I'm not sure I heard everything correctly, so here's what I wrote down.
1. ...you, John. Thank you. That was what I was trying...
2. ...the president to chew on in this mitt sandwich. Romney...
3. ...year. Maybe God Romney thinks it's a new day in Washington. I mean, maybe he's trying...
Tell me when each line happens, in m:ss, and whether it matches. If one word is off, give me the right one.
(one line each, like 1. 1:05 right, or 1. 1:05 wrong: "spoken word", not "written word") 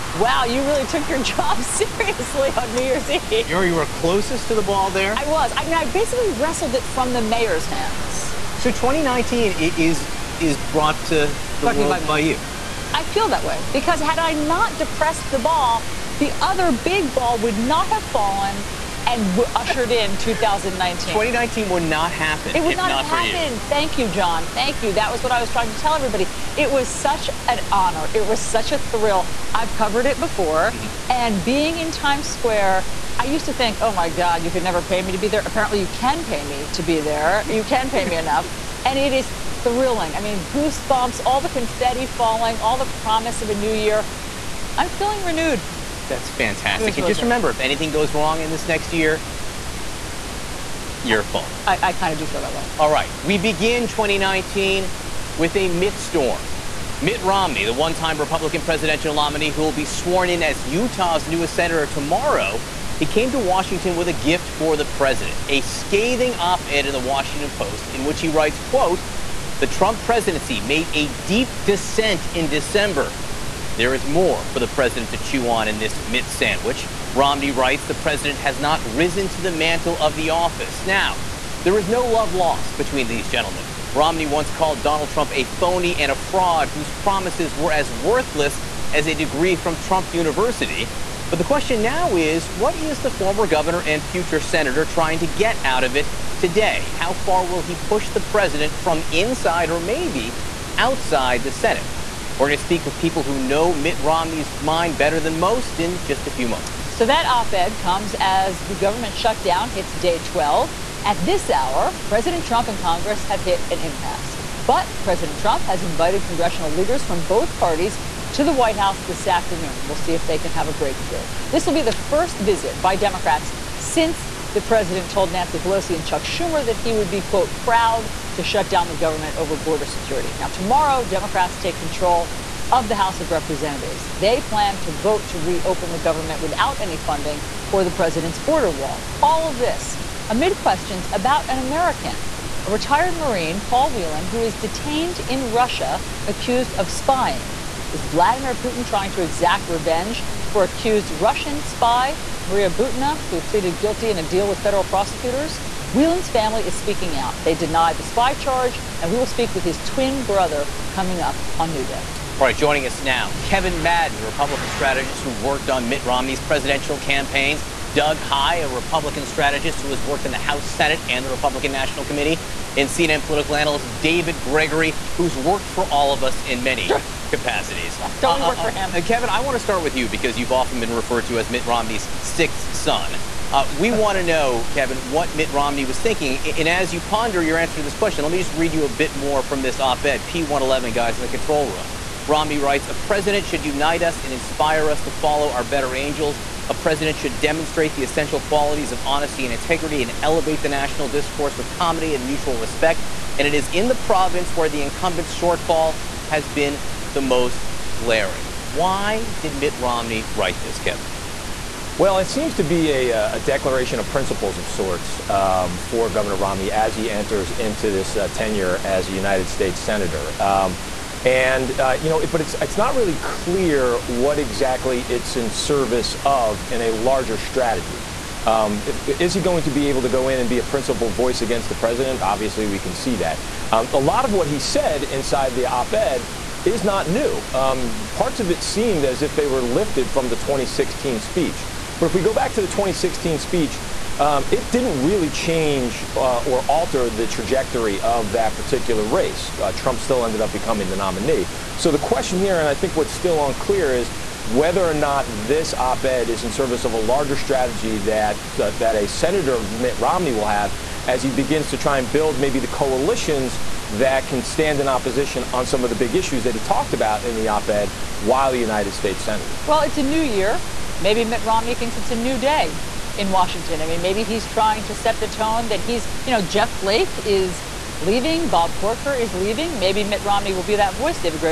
1. 0:23 right
2. 1:14 right
3. 4:30 wrong: "Mitt", not "God".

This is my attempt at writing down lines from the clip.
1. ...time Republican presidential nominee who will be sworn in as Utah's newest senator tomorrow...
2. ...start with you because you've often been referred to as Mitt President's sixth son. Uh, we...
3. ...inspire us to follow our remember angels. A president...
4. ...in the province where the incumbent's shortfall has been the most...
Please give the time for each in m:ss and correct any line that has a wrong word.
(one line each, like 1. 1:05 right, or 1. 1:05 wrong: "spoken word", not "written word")
1. 0:57 right
2. 2:59 wrong: "Romney", not "President"
3. 3:14 wrong: "better", not "remember"
4. 3:23 right.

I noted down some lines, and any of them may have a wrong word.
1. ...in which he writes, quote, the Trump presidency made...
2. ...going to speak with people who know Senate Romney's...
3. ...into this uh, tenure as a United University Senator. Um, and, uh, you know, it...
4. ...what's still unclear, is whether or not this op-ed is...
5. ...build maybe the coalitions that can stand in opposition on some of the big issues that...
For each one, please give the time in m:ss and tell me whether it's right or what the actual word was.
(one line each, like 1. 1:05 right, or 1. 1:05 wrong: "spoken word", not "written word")
1. 1:07 right
2. 1:42 wrong: "Mitt", not "Senate"
3. 3:37 wrong: "States", not "University"
4. 4:12 right
5. 4:22 right.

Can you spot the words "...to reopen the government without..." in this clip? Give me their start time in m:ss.
2:15.